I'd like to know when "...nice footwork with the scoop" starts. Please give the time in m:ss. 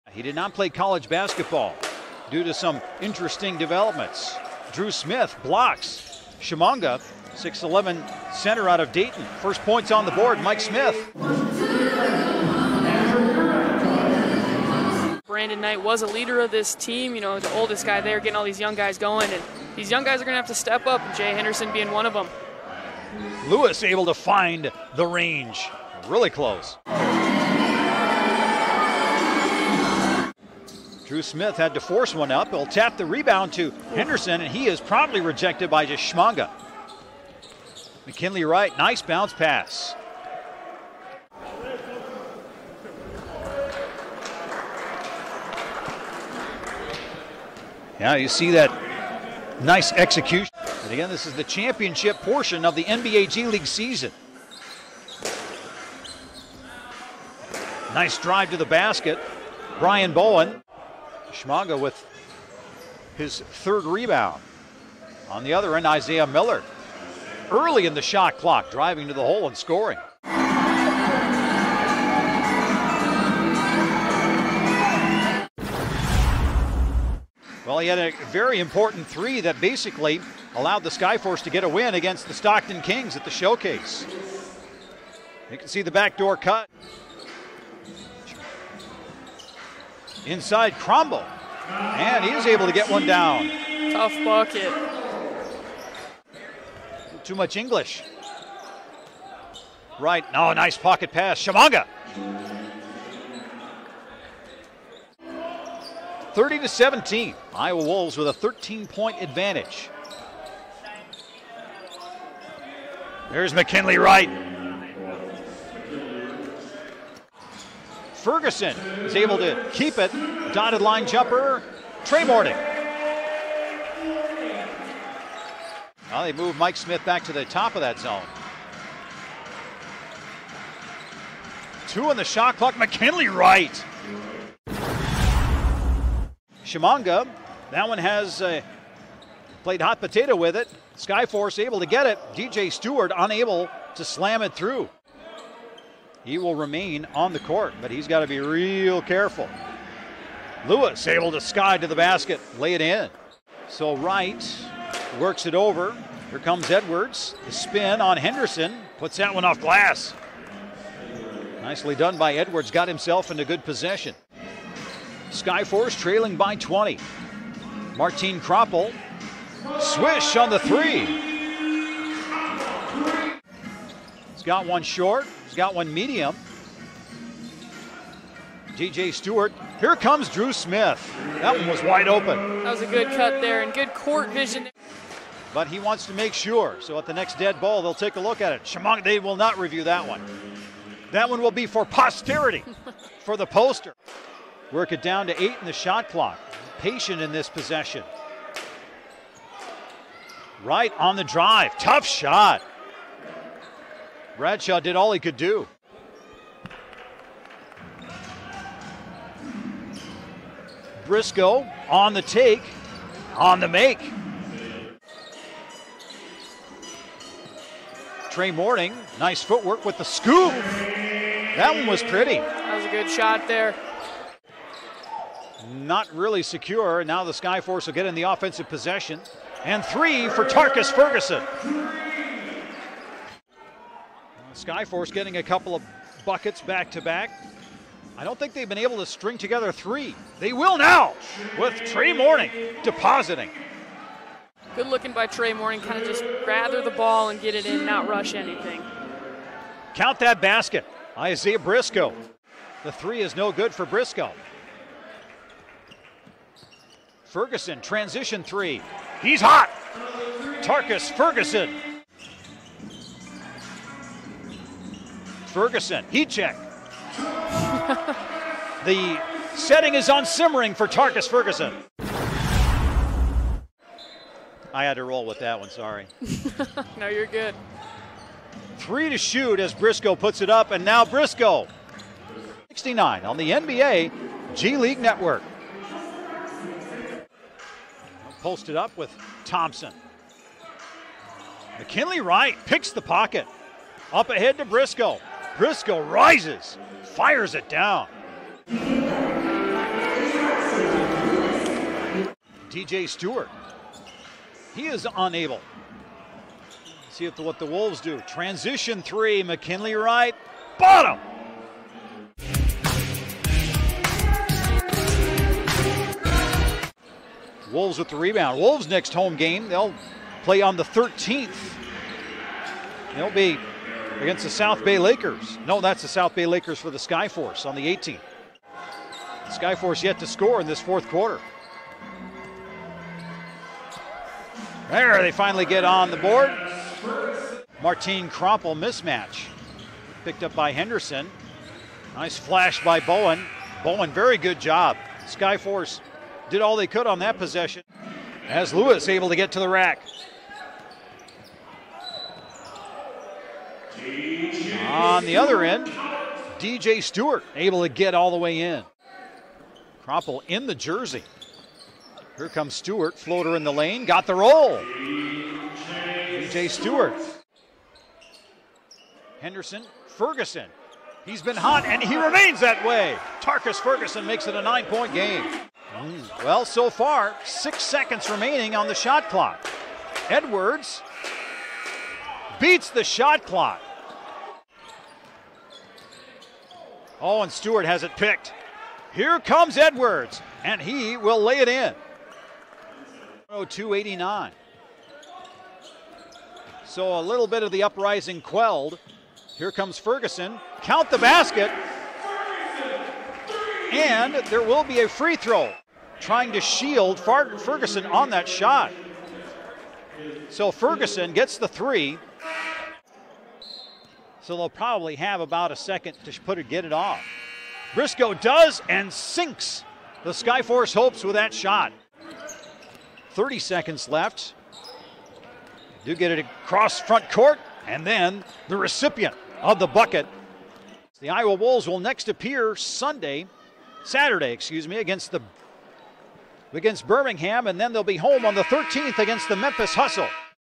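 3:39.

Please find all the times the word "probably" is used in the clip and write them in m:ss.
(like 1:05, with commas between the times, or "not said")
6:54.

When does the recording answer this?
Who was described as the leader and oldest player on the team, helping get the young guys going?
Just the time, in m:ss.
0:15.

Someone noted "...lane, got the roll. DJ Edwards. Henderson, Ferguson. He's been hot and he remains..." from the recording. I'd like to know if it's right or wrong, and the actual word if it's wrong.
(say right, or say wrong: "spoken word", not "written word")
wrong: "Stewart", not "Edwards".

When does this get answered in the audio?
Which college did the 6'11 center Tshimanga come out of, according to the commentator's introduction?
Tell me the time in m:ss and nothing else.
0:08.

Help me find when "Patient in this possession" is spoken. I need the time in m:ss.
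3:16.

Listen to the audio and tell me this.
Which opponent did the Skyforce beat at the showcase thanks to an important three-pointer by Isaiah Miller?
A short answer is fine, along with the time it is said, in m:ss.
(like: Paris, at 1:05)
Stockton Kings, at 1:22.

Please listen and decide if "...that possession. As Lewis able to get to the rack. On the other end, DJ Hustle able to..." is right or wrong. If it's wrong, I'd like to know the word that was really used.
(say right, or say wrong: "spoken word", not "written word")
wrong: "Stewart", not "Hustle".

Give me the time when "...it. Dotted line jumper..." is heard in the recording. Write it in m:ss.
1:59.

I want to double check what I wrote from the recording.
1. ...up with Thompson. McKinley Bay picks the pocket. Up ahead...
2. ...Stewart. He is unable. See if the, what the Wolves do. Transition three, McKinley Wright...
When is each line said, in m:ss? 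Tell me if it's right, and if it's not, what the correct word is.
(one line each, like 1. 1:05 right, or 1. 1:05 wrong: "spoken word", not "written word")
1. 4:48 wrong: "Wright", not "Bay"
2. 5:03 right.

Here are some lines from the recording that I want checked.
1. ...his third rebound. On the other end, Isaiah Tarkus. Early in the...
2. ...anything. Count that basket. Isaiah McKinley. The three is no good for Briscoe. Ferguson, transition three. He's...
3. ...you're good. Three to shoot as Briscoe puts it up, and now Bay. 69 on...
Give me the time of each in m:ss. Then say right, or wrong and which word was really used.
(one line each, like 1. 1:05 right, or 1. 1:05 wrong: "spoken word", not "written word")
1. 1:03 wrong: "Miller", not "Tarkus"
2. 4:08 wrong: "Briscoe", not "McKinley"
3. 4:37 wrong: "Briscoe", not "Bay".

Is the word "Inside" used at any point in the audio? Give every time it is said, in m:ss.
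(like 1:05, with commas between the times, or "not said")
1:30.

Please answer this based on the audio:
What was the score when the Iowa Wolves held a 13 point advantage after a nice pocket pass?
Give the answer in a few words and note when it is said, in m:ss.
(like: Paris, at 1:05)
30 to 17, at 1:46.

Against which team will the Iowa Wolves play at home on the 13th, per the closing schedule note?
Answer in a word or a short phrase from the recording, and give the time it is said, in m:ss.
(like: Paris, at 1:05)
Memphis Hustle, at 7:19.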